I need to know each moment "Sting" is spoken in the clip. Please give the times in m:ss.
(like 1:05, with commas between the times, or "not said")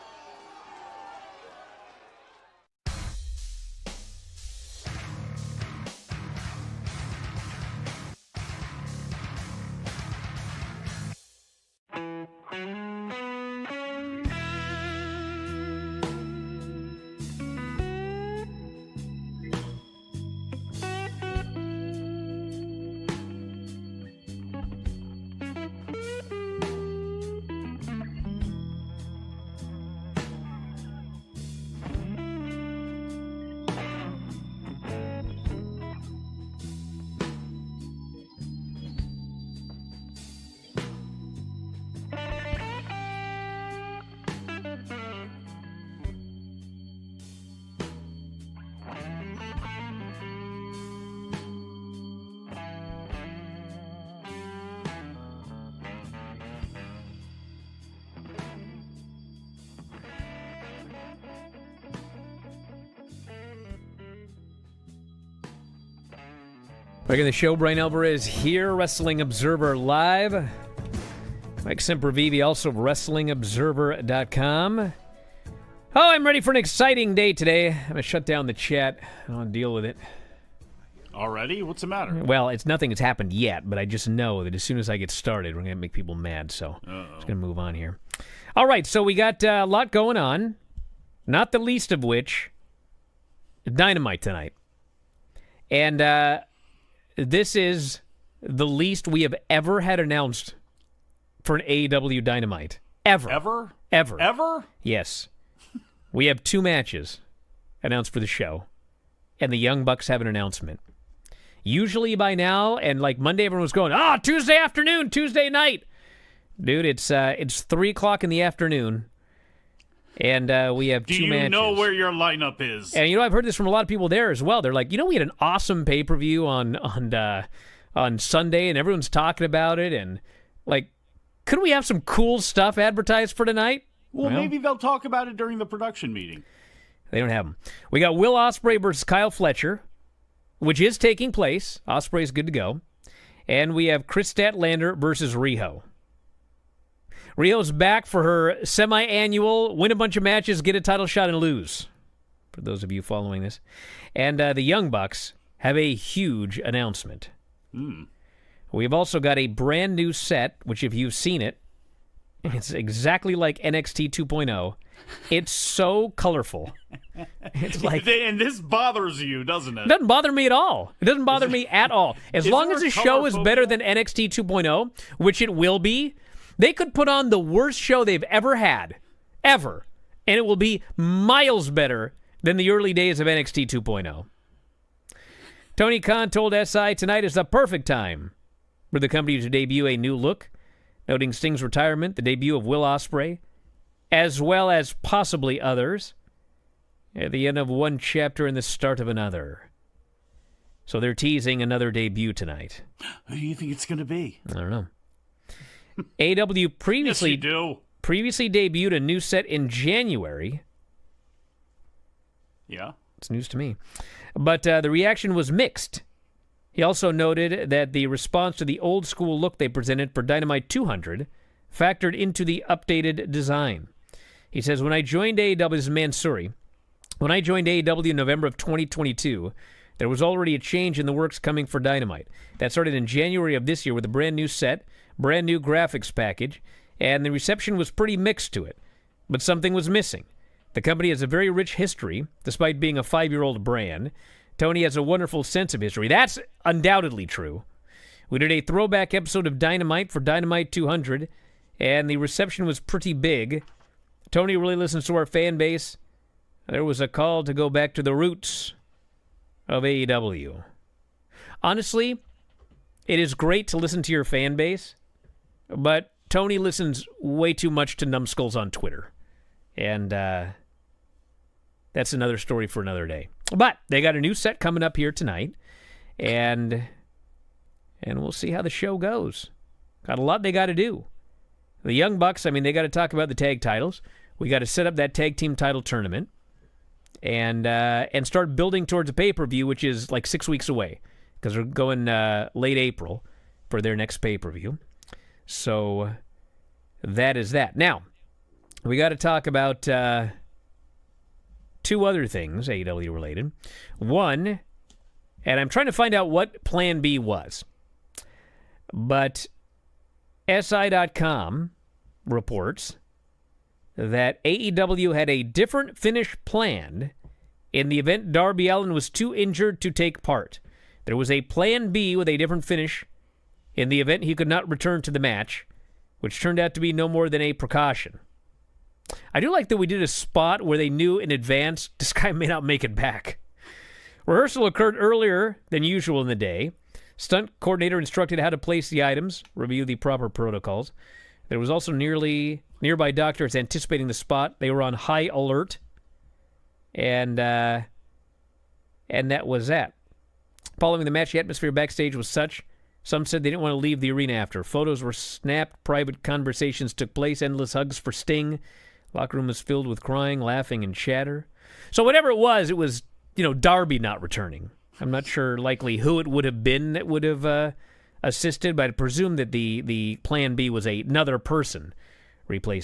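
3:11, 5:58.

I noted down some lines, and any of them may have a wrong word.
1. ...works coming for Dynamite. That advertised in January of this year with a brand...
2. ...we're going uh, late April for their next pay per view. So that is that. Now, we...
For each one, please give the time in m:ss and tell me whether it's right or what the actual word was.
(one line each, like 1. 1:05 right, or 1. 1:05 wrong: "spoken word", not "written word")
1. 3:51 wrong: "started", not "advertised"
2. 4:51 right.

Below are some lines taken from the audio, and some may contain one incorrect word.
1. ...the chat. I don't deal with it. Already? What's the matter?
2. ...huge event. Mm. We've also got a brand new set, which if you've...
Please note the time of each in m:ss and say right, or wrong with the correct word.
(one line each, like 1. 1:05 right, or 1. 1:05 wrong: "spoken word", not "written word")
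1. 1:18 right
2. 2:35 wrong: "announcement", not "event".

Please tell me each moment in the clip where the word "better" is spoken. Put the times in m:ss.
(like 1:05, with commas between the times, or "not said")
2:53, 3:01.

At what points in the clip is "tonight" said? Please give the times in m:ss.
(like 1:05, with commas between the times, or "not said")
1:34, 2:13, 3:06, 3:22, 4:35.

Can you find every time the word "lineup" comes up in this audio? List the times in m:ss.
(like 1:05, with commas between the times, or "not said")
2:02.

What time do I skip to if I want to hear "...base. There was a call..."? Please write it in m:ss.
4:15.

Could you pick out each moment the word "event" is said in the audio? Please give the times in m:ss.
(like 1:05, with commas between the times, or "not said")
5:17, 5:23.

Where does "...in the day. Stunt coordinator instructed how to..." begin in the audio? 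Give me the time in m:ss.
5:36.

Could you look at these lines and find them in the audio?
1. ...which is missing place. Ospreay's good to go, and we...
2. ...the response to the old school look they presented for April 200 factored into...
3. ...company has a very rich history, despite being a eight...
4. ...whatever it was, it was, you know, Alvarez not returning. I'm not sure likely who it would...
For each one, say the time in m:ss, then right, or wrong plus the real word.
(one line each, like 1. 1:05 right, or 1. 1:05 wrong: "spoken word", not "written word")
1. 2:20 wrong: "taking", not "missing"
2. 3:37 wrong: "Dynamite", not "April"
3. 4:00 wrong: "five", not "eight"
4. 6:02 wrong: "Darby", not "Alvarez".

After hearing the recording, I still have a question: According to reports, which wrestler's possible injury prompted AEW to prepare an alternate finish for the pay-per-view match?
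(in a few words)
Darby Allin.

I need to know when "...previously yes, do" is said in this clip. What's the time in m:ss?
3:26.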